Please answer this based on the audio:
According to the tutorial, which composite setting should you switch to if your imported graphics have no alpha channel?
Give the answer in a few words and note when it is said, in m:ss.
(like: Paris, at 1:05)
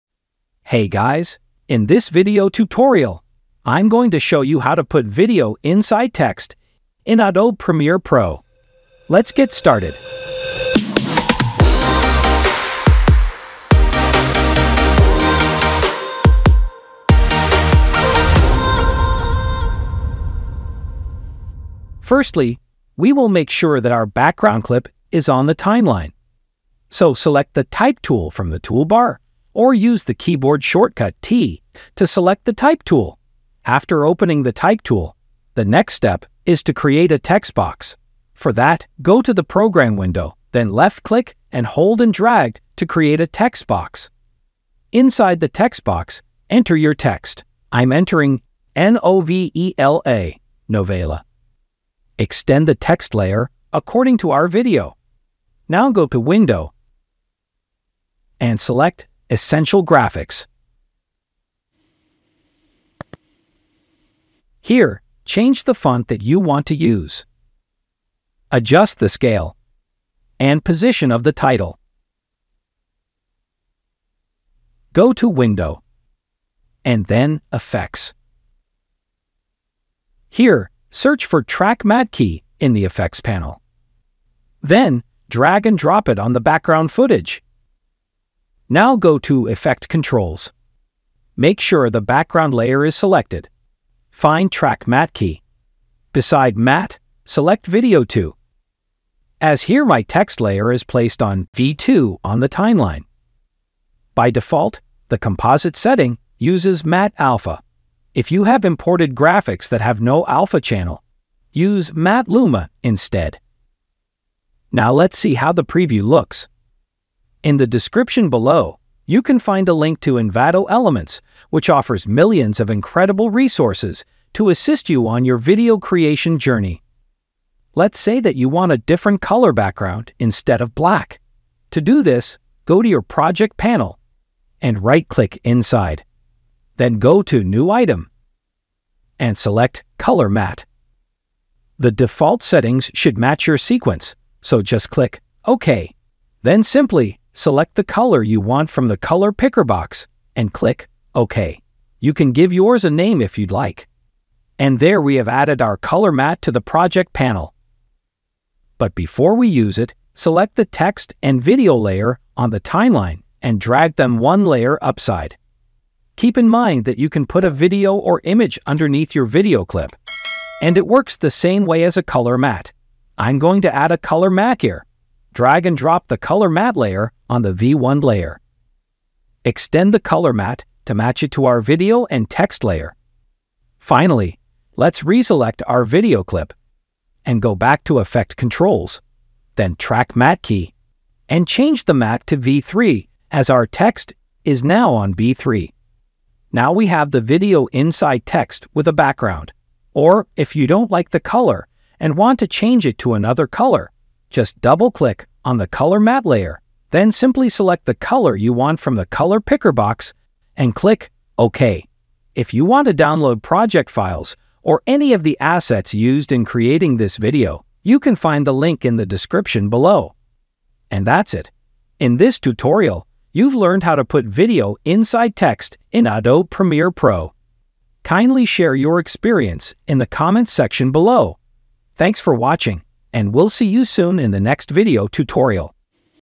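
Matte luma, at 1:51.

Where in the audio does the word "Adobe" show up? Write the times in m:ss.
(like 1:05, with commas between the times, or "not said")
0:07, 3:46.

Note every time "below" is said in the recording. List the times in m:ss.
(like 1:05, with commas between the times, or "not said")
1:58, 3:39, 3:50.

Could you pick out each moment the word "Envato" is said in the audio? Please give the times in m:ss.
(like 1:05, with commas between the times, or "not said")
2:00.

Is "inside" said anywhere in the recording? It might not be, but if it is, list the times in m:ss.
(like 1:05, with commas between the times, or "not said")
0:05, 0:44, 2:15, 3:17, 3:44.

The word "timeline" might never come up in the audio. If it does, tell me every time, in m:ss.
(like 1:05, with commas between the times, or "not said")
0:25, 1:42, 2:42.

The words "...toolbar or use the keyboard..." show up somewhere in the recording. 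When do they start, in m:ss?
0:28.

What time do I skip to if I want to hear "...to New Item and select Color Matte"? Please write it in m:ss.
2:17.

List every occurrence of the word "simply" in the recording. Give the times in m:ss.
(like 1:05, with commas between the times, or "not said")
2:26, 3:27.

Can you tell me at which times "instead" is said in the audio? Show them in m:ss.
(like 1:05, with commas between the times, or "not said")
1:52, 2:10.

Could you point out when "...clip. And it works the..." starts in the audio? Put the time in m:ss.
2:49.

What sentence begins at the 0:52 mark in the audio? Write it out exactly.
Extend the text layer according to our video.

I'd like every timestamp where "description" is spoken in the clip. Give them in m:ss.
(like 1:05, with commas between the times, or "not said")
1:57, 3:39.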